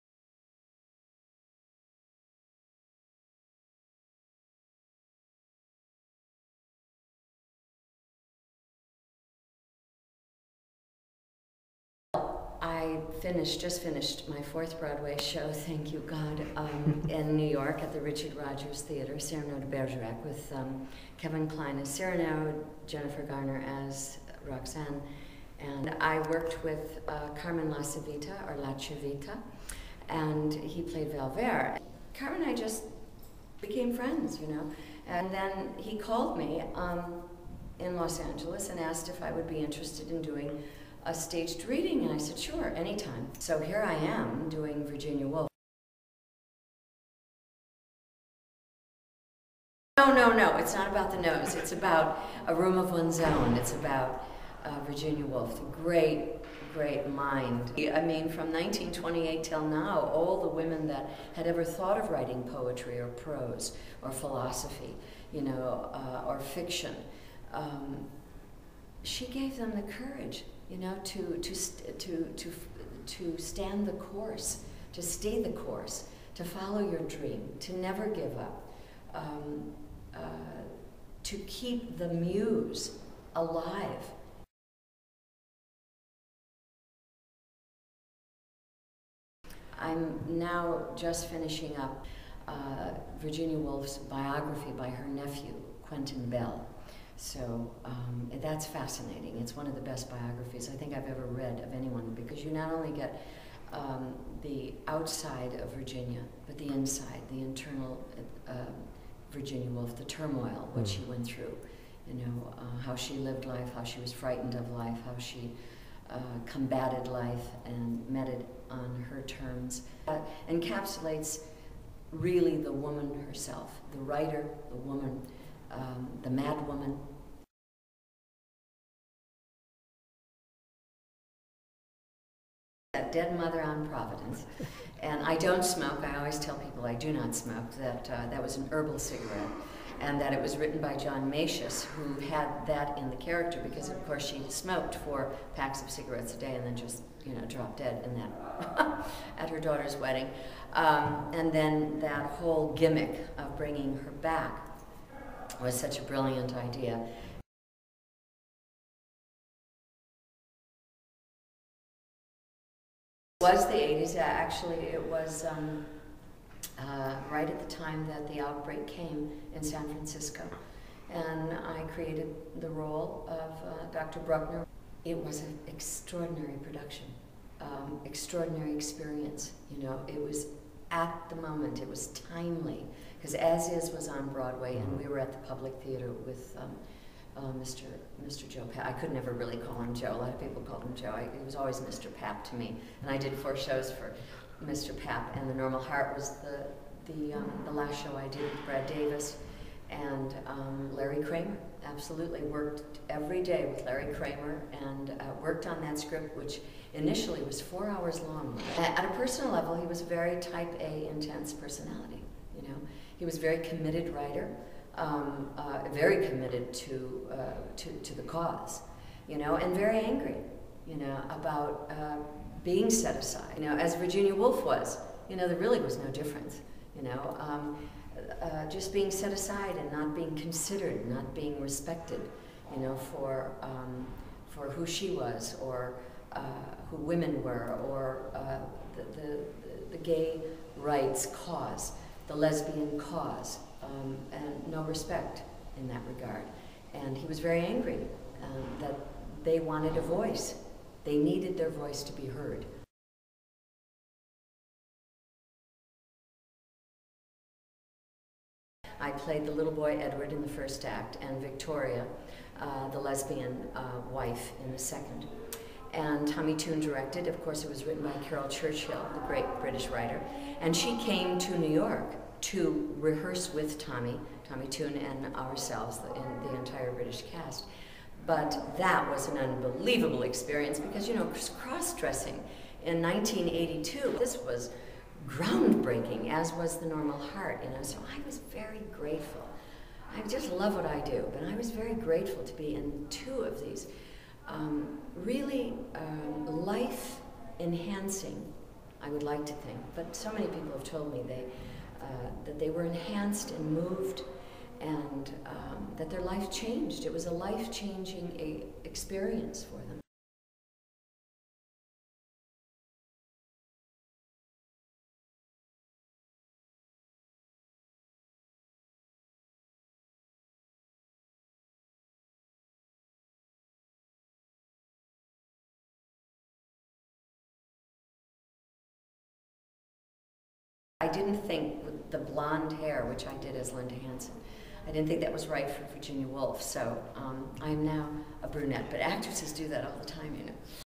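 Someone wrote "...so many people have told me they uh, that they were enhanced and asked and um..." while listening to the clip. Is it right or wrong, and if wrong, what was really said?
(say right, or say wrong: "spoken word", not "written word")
wrong: "moved", not "asked".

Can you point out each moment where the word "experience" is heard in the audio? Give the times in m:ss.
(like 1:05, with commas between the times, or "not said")
2:58, 4:40, 5:08.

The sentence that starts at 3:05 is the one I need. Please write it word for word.
we were at the Public Theater with.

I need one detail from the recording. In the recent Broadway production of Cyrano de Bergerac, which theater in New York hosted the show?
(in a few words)
Richard Rodgers Theater.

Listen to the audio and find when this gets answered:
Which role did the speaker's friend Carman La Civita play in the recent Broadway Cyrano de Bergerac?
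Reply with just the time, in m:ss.
0:31.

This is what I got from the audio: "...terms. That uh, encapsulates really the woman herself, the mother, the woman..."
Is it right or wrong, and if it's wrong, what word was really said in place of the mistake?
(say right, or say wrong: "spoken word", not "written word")
wrong: "writer", not "mother".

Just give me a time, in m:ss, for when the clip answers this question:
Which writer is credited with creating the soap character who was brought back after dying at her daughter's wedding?
2:20.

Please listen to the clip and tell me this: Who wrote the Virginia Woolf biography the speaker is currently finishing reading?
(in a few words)
Quentin Bell.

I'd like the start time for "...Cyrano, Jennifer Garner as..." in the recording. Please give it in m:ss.
0:21.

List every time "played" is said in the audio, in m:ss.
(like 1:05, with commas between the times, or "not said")
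0:30, 4:19.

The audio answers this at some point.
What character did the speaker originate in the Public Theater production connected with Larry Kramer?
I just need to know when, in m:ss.
2:53.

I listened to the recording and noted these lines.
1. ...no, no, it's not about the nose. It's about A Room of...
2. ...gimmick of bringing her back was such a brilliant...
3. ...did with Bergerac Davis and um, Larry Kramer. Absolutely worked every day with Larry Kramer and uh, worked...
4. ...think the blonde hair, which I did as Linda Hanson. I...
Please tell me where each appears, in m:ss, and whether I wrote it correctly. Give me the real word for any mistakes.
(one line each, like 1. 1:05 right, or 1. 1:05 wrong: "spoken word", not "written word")
1. 0:50 right
2. 2:32 right
3. 3:18 wrong: "Brad", not "Bergerac"
4. 5:31 right.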